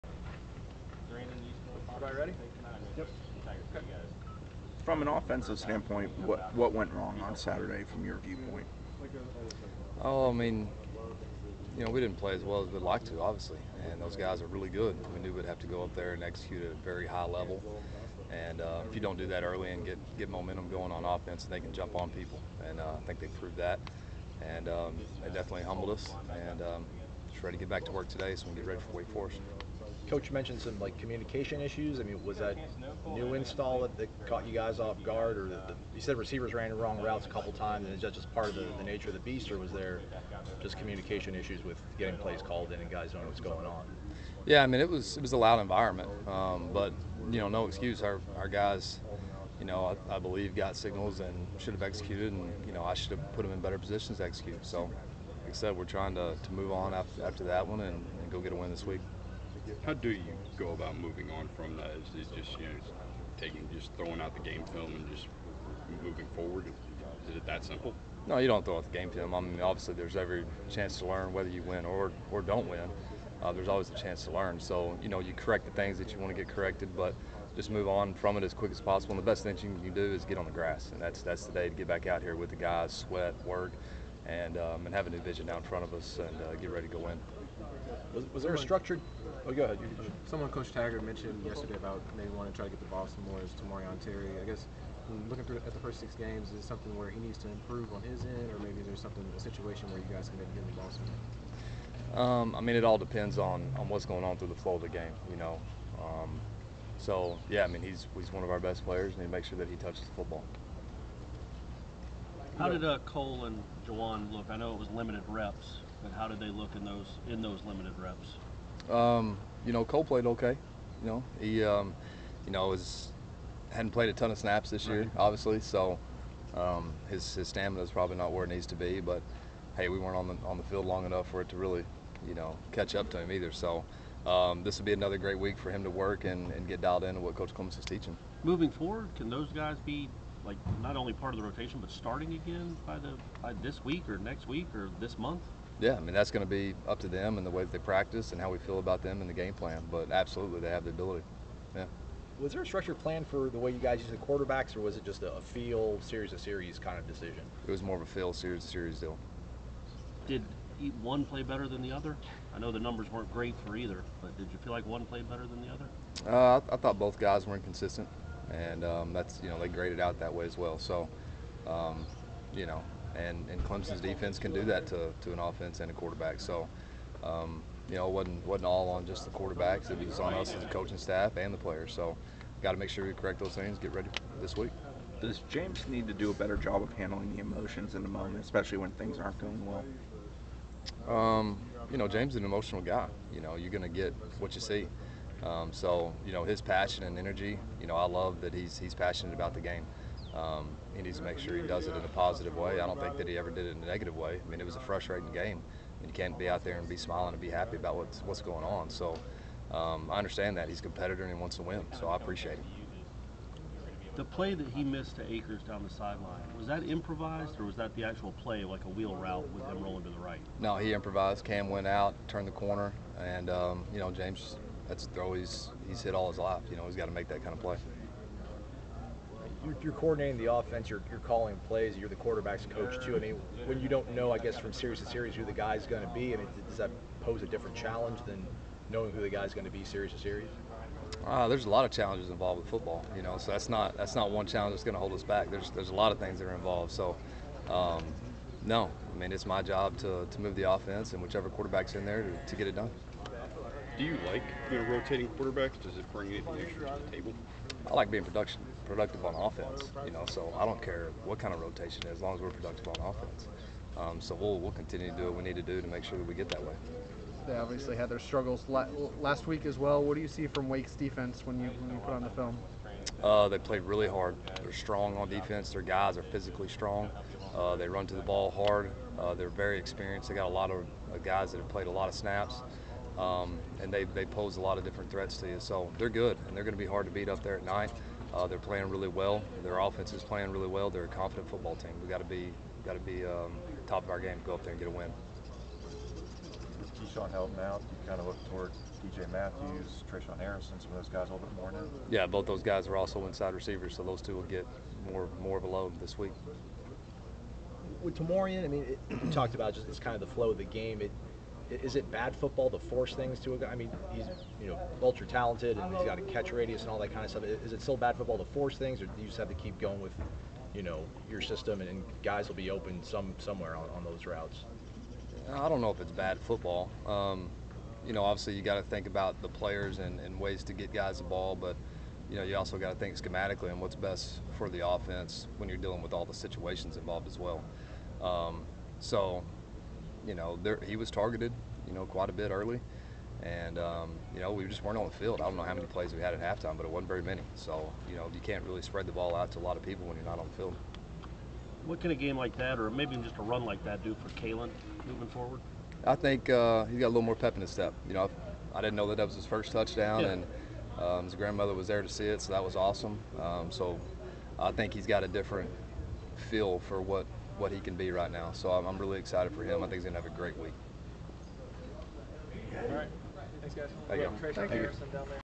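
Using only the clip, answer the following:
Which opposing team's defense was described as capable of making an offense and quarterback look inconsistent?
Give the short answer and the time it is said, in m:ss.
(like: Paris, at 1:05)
Clemson, at 2:53.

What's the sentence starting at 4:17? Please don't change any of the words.
I like being production productive on offense.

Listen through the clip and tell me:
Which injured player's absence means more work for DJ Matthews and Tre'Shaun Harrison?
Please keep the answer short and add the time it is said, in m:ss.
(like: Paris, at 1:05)
Keyshawn Helton, at 4:56.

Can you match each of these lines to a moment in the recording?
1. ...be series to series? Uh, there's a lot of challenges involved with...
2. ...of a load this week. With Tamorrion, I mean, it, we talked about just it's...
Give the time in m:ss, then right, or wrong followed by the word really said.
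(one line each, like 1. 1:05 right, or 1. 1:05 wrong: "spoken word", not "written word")
1. 3:59 right
2. 5:05 right.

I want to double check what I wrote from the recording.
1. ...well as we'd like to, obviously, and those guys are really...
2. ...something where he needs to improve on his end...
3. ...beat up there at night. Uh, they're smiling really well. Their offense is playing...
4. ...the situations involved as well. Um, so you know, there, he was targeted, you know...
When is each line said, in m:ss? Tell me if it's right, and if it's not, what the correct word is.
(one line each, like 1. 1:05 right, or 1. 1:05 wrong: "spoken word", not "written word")
1. 0:12 right
2. 1:36 right
3. 4:47 wrong: "playing", not "smiling"
4. 5:36 right.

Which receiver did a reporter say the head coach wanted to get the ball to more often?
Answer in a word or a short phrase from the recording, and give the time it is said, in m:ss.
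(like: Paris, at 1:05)
Tamorrion Terry, at 1:33.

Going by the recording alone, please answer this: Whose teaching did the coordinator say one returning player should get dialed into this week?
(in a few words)
Coach Clements.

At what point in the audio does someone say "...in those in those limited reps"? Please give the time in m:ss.
1:56.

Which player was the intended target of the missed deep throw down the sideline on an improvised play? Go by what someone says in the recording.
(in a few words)
Akers.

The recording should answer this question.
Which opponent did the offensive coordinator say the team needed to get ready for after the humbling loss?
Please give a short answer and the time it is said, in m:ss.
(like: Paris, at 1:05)
Wake Forest, at 0:28.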